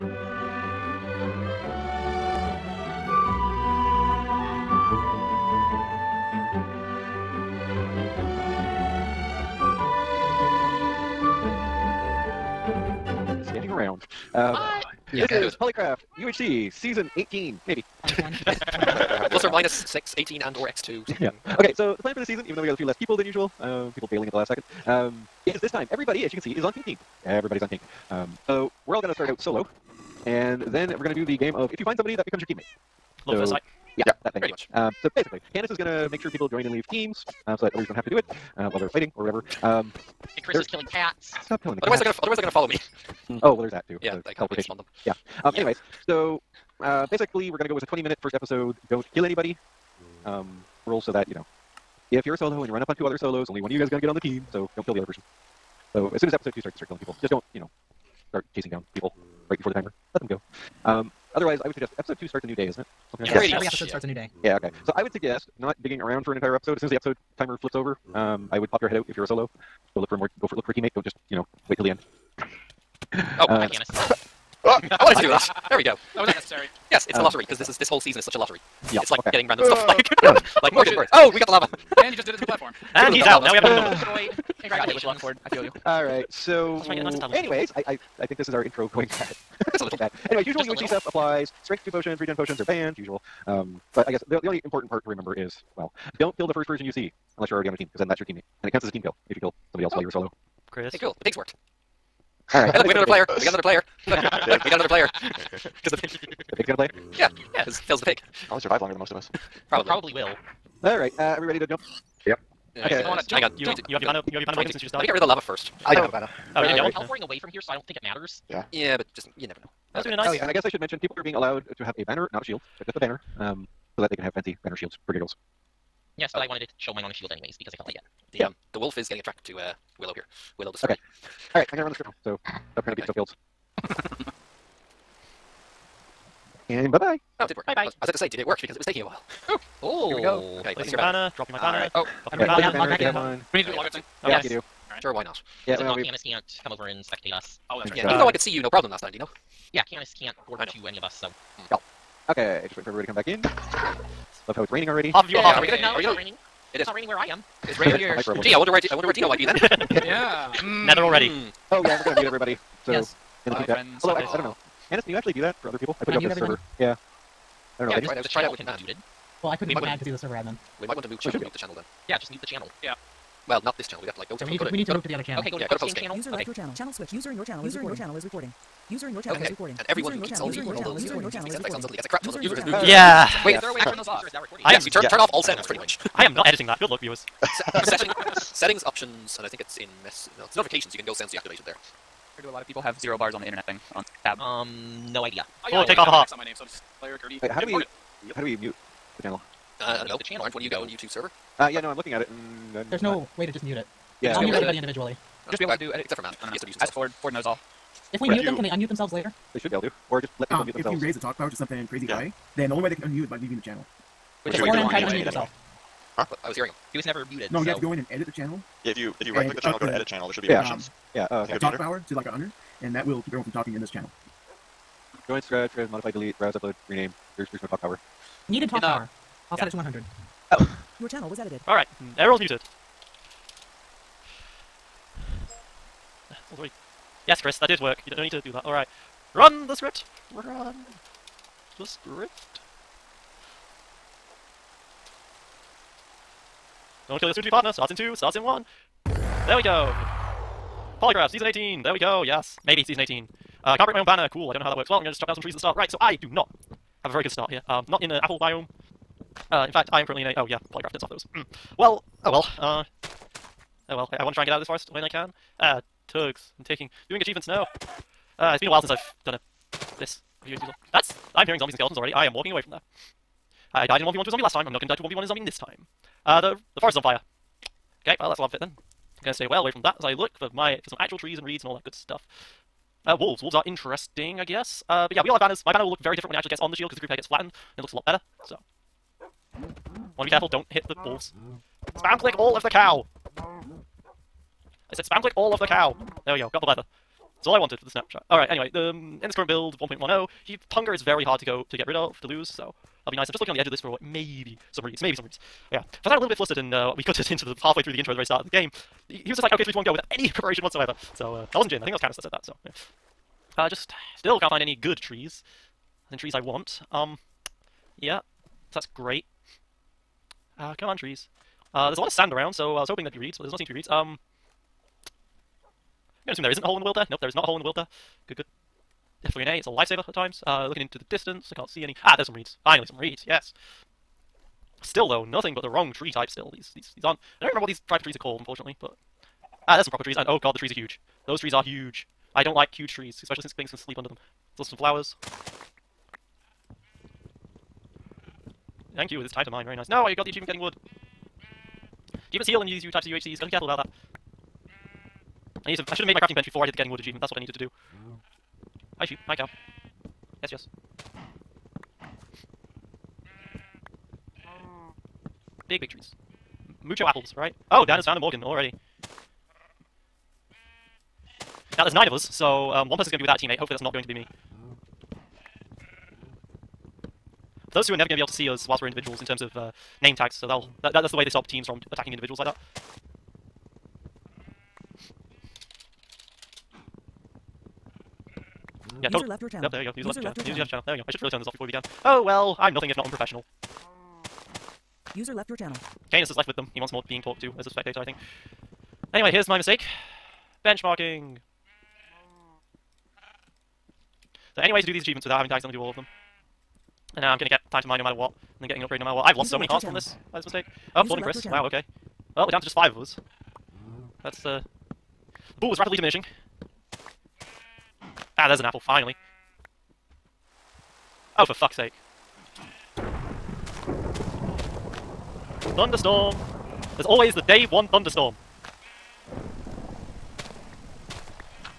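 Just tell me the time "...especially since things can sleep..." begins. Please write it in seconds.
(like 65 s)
343 s.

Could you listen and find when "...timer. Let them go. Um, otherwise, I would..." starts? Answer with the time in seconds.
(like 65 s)
59 s.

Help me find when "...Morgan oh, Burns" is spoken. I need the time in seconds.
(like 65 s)
80 s.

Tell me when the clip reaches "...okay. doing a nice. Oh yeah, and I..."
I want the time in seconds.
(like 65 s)
120 s.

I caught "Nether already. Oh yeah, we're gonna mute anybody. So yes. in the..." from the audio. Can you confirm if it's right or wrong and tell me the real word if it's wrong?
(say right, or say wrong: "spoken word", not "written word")
wrong: "everybody", not "anybody".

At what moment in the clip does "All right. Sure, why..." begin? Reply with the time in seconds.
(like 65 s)
144 s.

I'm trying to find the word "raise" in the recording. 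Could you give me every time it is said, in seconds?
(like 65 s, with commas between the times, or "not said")
211 s.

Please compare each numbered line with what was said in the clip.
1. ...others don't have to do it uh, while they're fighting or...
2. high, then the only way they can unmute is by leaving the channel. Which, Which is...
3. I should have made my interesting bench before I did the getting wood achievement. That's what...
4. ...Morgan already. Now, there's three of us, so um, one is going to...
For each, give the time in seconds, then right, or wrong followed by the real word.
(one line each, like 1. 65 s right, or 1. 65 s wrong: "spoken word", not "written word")
1. 37 s right
2. 212 s right
3. 355 s wrong: "crafting", not "interesting"
4. 368 s wrong: "nine", not "three".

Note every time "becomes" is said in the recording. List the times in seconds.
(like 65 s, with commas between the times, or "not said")
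32 s.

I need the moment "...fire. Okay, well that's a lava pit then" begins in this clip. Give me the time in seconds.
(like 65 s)
277 s.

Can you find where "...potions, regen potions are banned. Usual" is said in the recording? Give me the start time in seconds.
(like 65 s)
91 s.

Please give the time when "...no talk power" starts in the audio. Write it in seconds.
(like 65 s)
227 s.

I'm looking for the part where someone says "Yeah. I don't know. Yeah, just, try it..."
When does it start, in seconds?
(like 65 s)
166 s.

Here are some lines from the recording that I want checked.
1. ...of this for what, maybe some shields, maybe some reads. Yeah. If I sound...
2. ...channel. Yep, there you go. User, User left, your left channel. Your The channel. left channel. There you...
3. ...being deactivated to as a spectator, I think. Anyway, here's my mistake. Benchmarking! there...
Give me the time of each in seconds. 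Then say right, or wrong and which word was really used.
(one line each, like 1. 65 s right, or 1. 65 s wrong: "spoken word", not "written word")
1. 303 s wrong: "reads", not "shields"
2. 389 s wrong: "User", not "The"
3. 397 s wrong: "talked", not "deactivated".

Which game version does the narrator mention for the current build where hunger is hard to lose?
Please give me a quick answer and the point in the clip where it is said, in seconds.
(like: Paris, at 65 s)
1.10, at 299 s.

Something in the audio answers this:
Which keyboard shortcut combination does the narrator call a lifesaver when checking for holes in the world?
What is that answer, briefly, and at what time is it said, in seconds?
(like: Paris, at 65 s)
F3 and A, at 329 s.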